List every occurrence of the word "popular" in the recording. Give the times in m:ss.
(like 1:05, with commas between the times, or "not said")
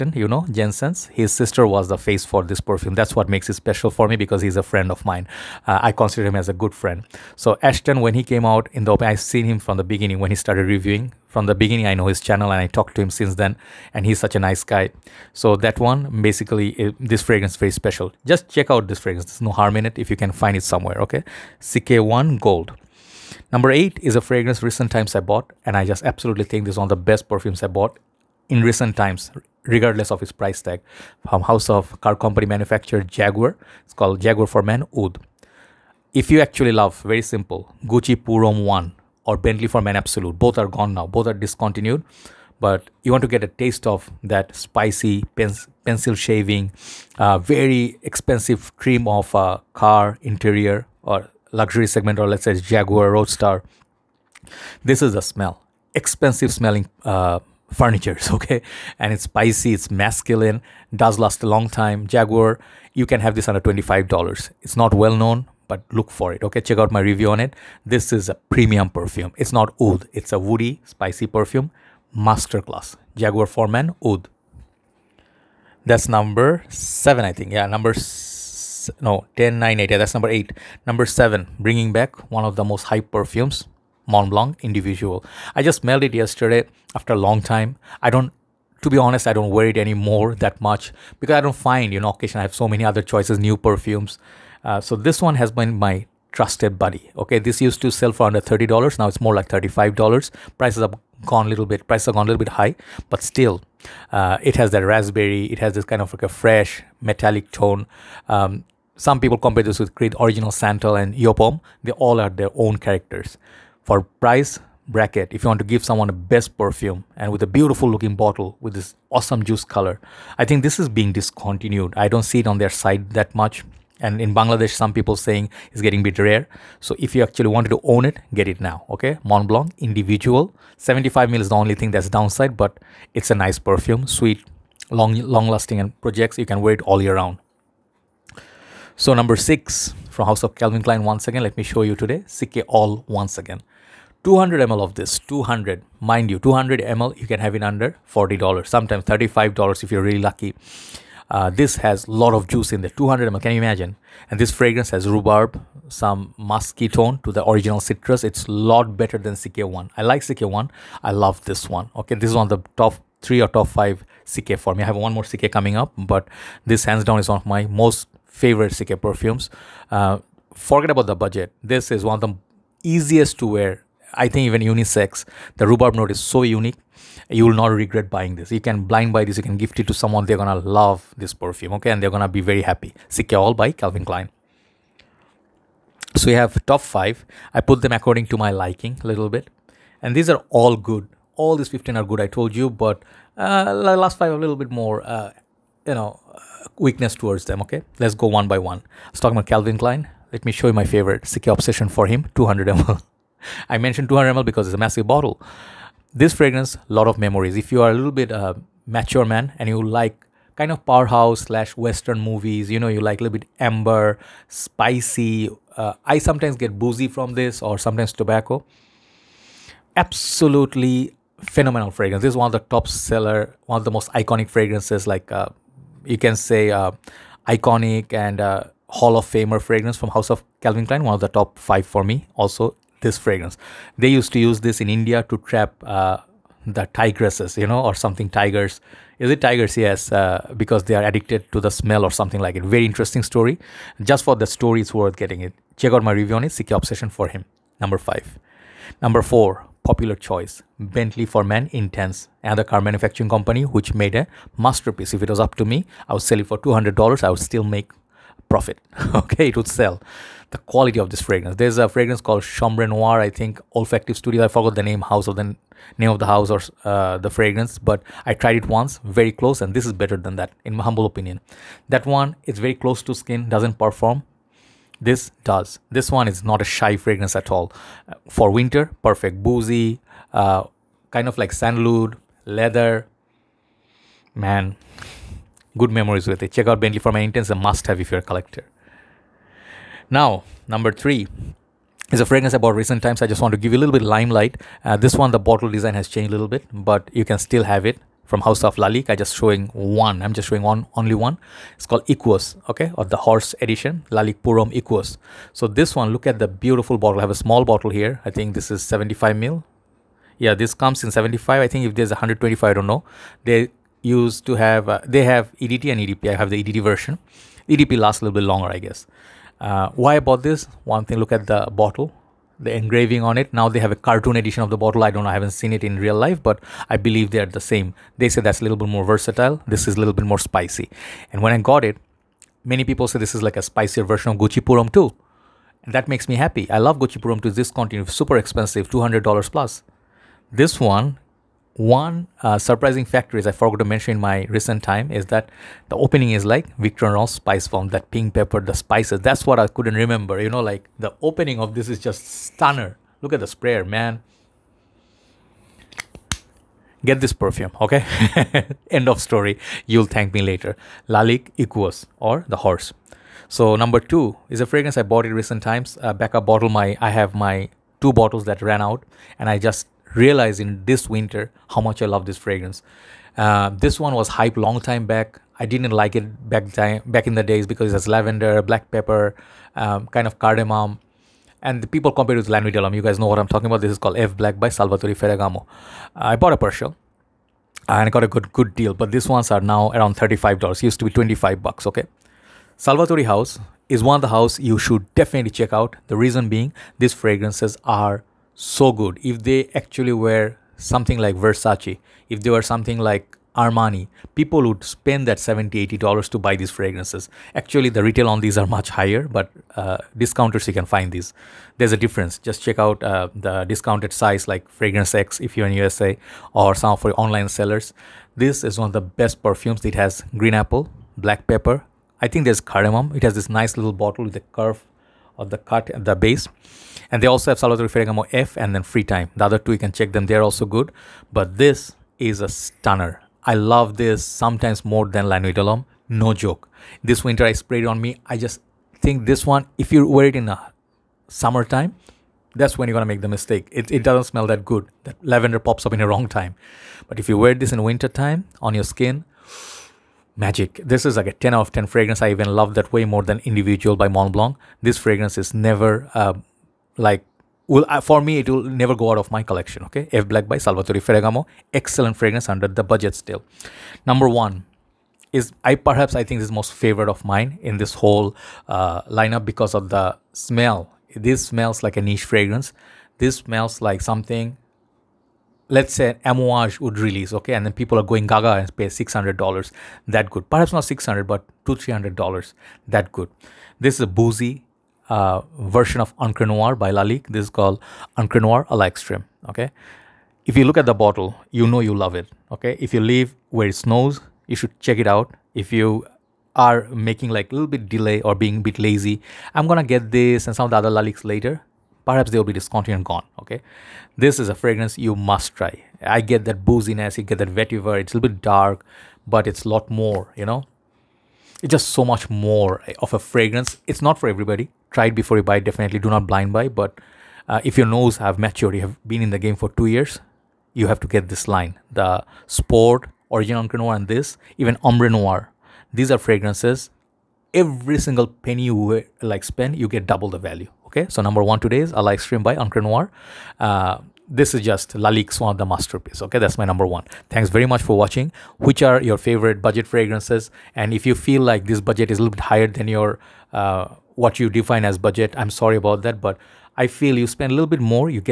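4:09.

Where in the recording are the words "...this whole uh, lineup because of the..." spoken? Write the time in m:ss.
7:47.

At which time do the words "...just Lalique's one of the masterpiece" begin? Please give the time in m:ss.
8:54.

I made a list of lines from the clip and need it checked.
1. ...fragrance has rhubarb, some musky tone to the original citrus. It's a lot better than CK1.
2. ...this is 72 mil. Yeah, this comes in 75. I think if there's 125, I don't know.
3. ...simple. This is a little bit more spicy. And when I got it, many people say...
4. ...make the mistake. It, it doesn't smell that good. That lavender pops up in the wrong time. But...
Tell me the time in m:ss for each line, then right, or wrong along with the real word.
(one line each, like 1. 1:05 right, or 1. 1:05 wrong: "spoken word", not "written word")
1. 2:34 right
2. 5:08 wrong: "75", not "72"
3. 5:29 wrong: "versatile", not "simple"
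4. 7:23 right.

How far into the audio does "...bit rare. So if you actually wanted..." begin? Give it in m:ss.
2:06.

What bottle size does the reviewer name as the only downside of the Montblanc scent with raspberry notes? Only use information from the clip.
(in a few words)
75 ml.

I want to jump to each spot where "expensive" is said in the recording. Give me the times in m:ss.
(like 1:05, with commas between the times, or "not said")
0:48, 0:55, 5:38.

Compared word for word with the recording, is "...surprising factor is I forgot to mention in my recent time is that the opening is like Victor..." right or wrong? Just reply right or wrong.
right.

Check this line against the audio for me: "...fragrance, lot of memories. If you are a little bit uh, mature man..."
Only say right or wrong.
right.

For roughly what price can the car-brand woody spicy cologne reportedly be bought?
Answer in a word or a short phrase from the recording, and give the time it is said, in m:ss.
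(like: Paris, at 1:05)
under $25, at 1:03.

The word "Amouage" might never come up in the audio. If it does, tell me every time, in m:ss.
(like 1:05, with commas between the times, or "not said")
7:56.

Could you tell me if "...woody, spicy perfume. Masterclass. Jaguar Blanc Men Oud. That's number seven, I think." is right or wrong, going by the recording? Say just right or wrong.
wrong.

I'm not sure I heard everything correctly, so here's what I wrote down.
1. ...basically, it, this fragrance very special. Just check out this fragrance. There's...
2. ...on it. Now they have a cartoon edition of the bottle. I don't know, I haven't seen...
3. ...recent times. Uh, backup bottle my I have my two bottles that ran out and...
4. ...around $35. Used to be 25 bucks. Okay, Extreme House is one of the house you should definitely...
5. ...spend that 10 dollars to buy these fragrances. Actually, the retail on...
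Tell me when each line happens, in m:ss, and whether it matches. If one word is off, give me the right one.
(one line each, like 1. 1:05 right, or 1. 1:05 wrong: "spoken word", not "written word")
1. 0:16 right
2. 5:23 right
3. 6:05 right
4. 6:29 wrong: "Salvatore", not "Extreme"
5. 6:44 wrong: "70", not "10".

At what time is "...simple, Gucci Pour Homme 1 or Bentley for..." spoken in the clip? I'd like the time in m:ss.
0:37.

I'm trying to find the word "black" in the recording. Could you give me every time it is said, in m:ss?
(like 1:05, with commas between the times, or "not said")
6:18, 6:24, 7:01, 7:40.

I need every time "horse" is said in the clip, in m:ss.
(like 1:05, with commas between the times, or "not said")
5:03, 6:02.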